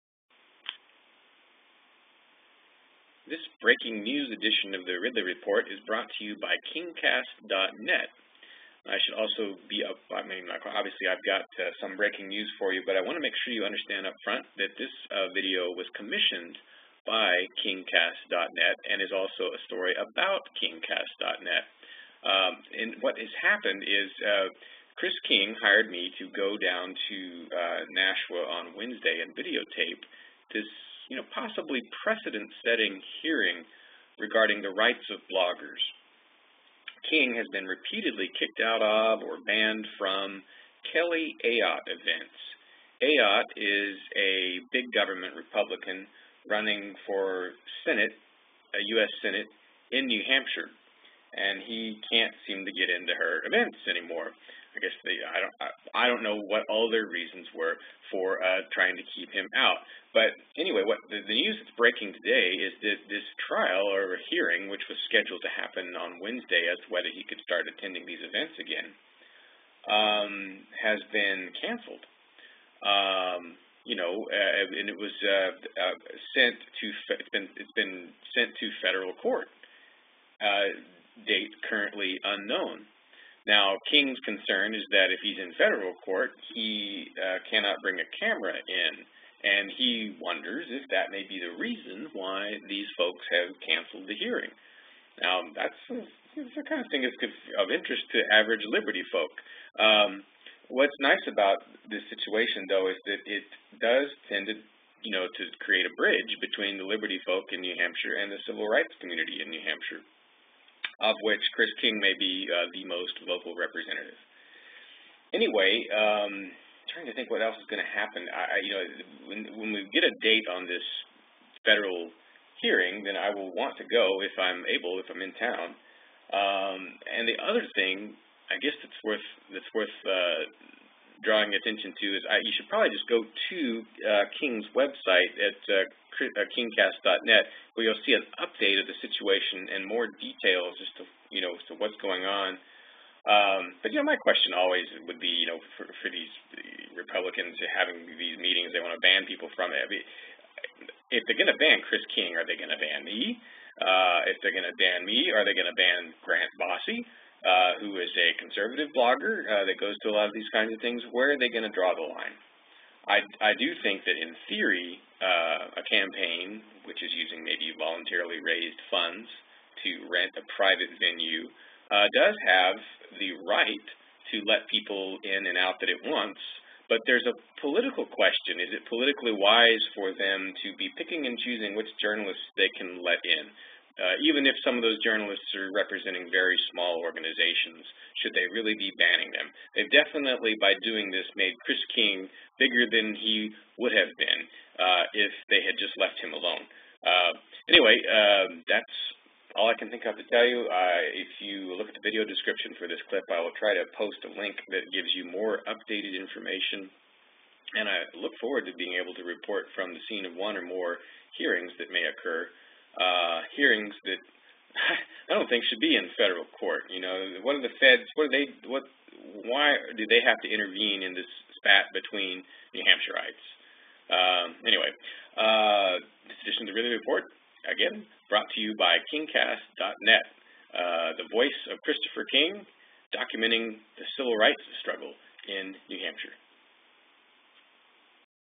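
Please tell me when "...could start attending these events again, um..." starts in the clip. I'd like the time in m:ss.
1:07.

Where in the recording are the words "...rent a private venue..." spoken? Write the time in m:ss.
2:50.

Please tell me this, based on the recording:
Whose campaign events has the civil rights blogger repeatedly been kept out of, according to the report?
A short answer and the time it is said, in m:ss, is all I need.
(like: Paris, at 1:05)
Kelly Ayotte, at 0:40.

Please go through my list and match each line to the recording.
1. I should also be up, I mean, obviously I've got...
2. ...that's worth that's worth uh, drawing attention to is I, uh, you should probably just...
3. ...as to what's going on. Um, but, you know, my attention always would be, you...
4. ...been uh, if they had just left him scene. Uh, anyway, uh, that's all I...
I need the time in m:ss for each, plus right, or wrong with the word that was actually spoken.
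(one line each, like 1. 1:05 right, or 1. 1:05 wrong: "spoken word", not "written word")
1. 0:08 right
2. 2:08 right
3. 2:21 wrong: "question", not "attention"
4. 3:14 wrong: "alone", not "scene".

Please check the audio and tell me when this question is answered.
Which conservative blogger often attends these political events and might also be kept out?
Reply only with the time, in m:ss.
2:36.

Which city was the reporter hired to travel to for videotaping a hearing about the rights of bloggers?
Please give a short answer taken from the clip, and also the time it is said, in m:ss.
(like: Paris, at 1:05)
Nashua, at 0:27.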